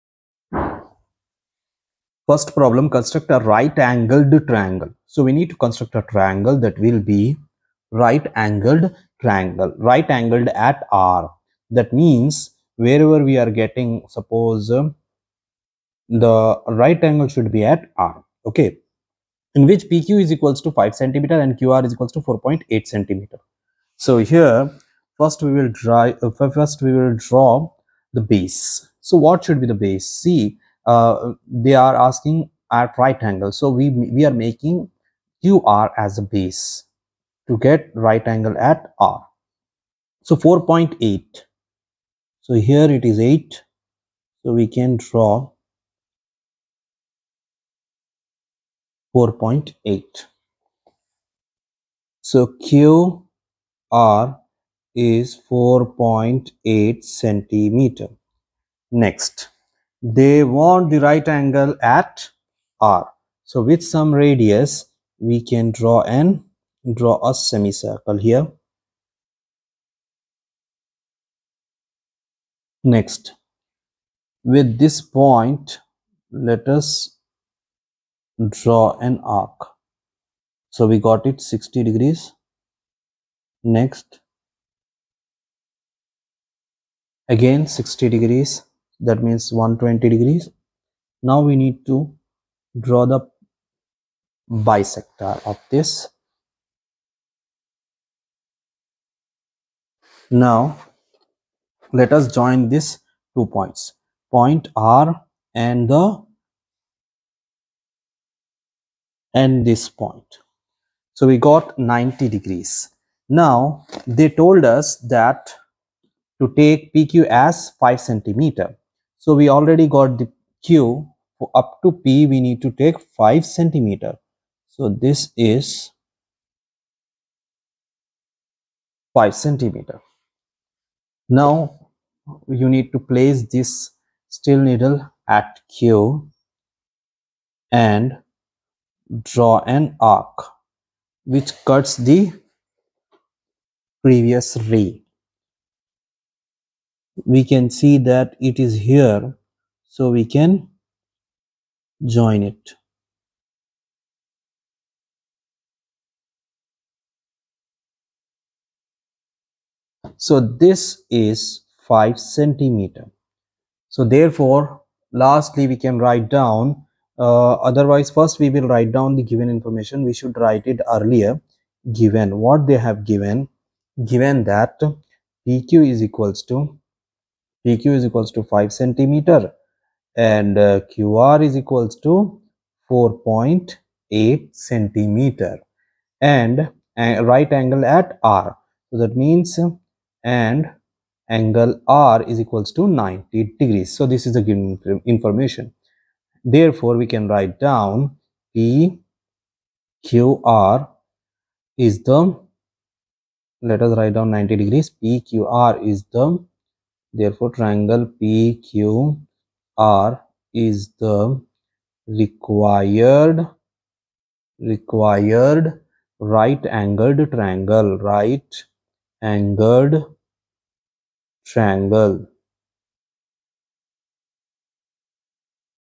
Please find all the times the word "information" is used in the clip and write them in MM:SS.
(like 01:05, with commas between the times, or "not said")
02:49, 03:15.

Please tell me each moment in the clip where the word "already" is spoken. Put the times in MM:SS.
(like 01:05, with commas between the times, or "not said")
01:59.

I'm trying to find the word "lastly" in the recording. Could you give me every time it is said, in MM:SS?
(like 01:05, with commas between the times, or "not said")
02:45.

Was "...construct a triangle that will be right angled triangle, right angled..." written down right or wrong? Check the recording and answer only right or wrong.
right.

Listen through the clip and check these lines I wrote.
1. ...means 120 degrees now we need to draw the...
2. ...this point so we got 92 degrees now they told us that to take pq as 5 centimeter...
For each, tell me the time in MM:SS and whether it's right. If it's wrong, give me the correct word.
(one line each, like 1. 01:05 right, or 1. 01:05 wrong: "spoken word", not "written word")
1. 01:29 right
2. 01:49 wrong: "90", not "92".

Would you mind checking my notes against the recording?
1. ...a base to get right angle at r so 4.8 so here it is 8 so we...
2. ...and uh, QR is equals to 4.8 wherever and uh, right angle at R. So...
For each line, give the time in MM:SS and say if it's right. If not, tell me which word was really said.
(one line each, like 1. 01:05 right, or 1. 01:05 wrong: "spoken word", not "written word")
1. 00:36 right
2. 03:00 wrong: "centimeter", not "wherever".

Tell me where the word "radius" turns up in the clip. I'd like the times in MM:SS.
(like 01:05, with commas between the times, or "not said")
01:04.